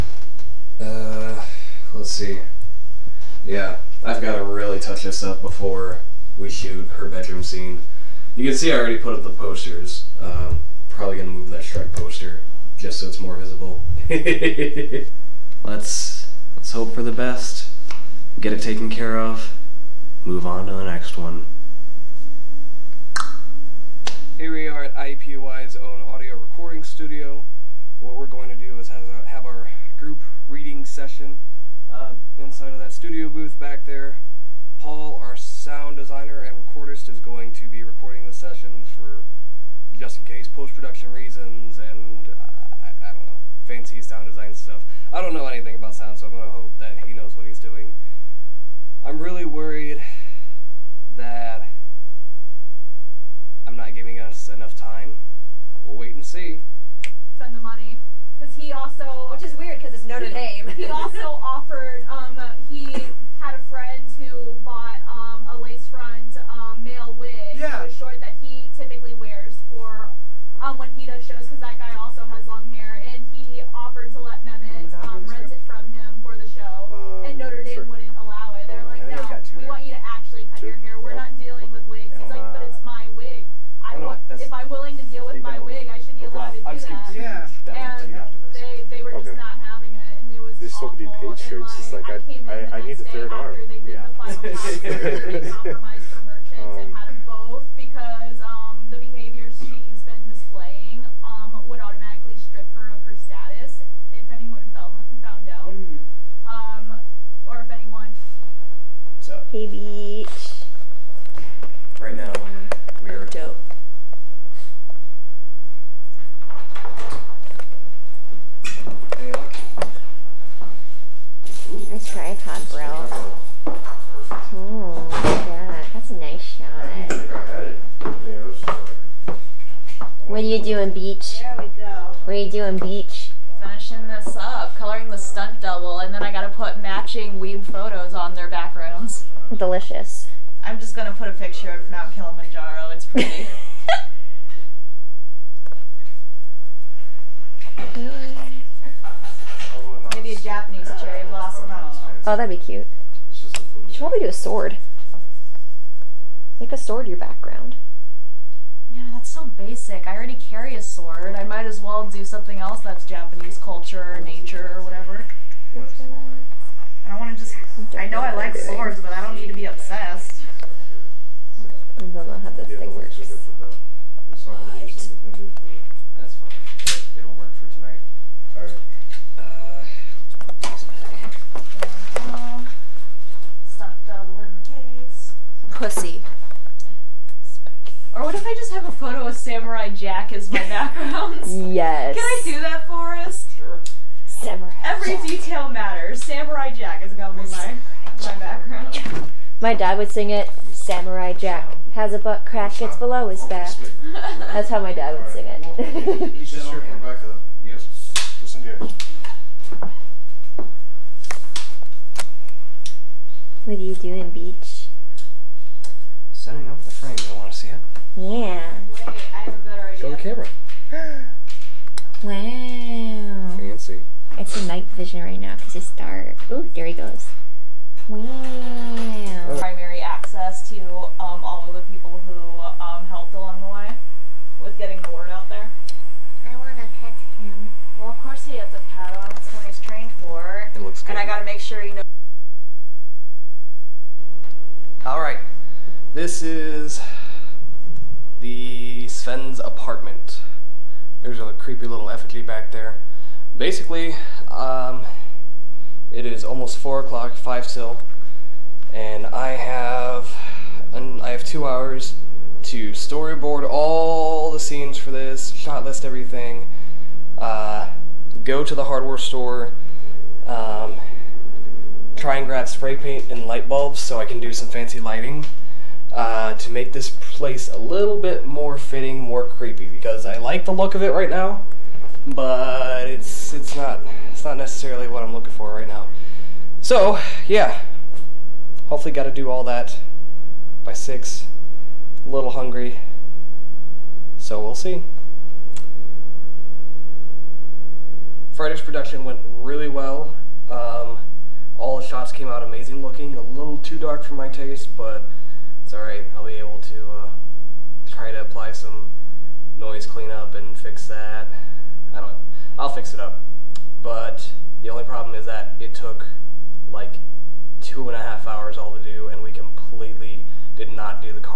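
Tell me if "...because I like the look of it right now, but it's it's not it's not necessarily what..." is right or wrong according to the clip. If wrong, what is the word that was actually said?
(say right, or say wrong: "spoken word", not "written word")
right.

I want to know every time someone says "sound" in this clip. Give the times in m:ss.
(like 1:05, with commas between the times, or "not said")
0:35, 0:44.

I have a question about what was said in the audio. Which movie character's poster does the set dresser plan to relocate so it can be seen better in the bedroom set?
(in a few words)
Shrek.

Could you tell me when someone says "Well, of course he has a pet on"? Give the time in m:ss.
3:57.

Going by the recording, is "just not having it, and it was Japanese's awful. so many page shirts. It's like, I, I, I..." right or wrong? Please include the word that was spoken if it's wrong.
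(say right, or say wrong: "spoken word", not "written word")
wrong: "There", not "Japanese".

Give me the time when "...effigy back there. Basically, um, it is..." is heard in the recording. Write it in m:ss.
4:12.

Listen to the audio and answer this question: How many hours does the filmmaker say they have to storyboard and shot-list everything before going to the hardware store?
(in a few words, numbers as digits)
2.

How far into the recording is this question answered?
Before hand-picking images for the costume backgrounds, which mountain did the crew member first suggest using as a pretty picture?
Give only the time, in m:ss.
2:21.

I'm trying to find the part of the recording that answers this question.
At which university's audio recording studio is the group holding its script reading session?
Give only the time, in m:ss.
0:24.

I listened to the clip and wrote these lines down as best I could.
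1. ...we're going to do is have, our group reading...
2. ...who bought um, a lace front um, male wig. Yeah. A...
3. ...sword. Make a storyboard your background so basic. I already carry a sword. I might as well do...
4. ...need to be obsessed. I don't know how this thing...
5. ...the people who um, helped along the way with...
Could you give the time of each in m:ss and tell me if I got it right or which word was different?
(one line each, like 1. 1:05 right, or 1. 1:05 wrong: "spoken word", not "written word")
1. 0:28 right
2. 1:04 right
3. 2:34 wrong: "sword", not "storyboard"
4. 2:49 right
5. 3:51 right.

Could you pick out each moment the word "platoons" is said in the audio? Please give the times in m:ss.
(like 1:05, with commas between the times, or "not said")
not said.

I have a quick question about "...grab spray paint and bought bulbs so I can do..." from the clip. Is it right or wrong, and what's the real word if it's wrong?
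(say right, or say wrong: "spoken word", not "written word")
wrong: "light", not "bought".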